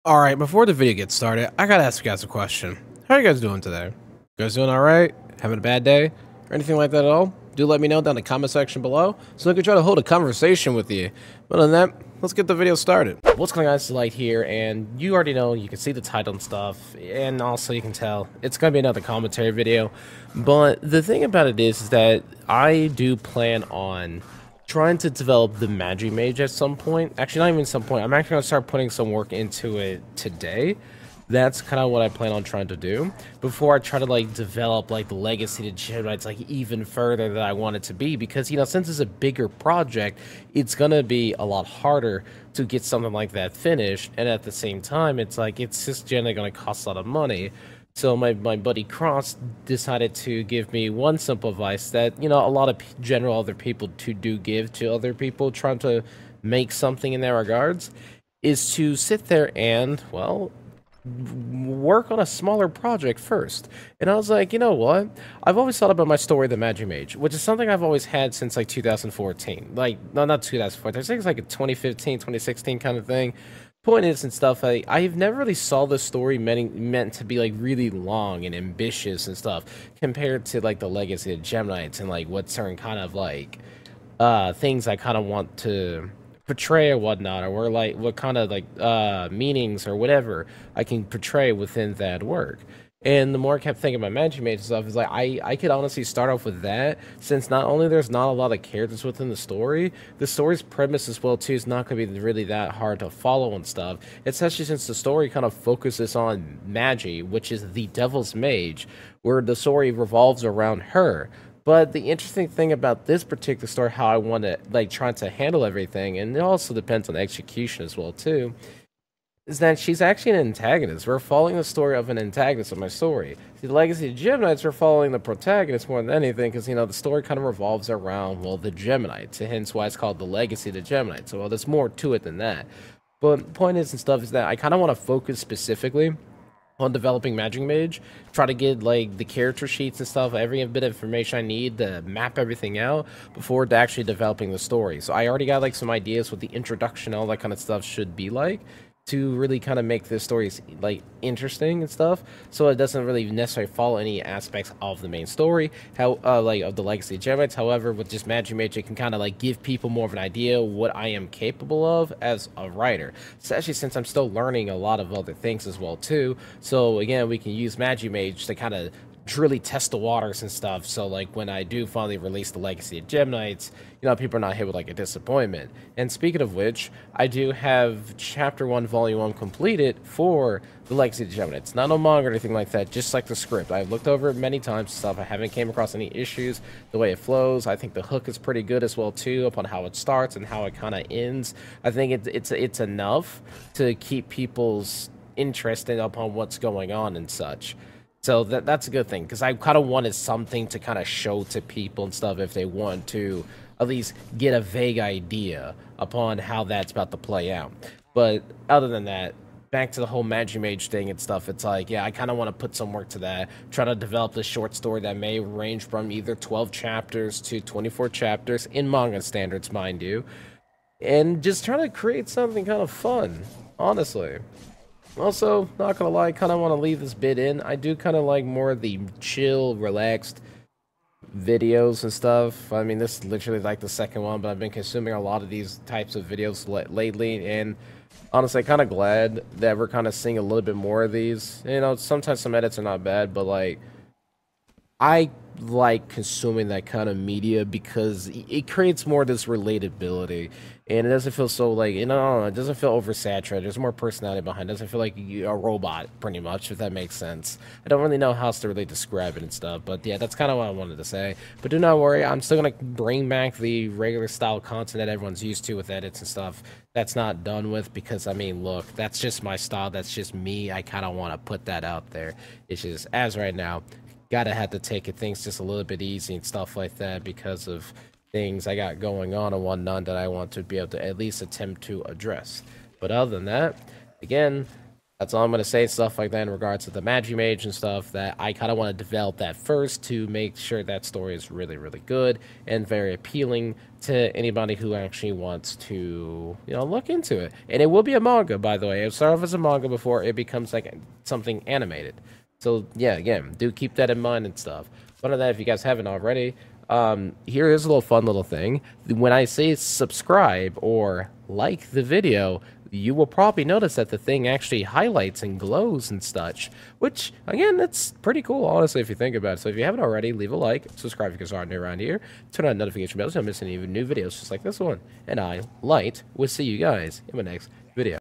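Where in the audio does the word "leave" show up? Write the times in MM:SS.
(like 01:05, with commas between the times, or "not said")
03:46, 05:20.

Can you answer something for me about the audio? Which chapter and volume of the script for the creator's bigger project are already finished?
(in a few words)
Chapter 1, Volume 1.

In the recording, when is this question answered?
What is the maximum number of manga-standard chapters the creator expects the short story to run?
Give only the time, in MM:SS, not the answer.
03:37.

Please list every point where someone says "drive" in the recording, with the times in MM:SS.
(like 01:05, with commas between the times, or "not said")
not said.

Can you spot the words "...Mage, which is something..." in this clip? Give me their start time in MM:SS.
01:06.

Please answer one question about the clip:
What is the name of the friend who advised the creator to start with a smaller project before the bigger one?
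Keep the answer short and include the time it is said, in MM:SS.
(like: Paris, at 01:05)
Cross, at 00:48.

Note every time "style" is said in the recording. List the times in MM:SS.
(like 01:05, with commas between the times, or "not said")
04:24, 04:29.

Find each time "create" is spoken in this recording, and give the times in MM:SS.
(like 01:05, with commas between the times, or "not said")
03:41, 04:08.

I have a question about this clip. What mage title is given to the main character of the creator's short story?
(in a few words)
the Devil's Mage.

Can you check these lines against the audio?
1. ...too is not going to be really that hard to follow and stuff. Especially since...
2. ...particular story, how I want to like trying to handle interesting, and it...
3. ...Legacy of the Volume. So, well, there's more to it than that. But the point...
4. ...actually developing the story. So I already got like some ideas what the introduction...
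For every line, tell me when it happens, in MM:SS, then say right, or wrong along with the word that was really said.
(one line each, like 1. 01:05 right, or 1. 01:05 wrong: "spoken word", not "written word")
1. 01:41 right
2. 01:53 wrong: "everything", not "interesting"
3. 02:10 wrong: "Geminites", not "Volume"
4. 02:23 right.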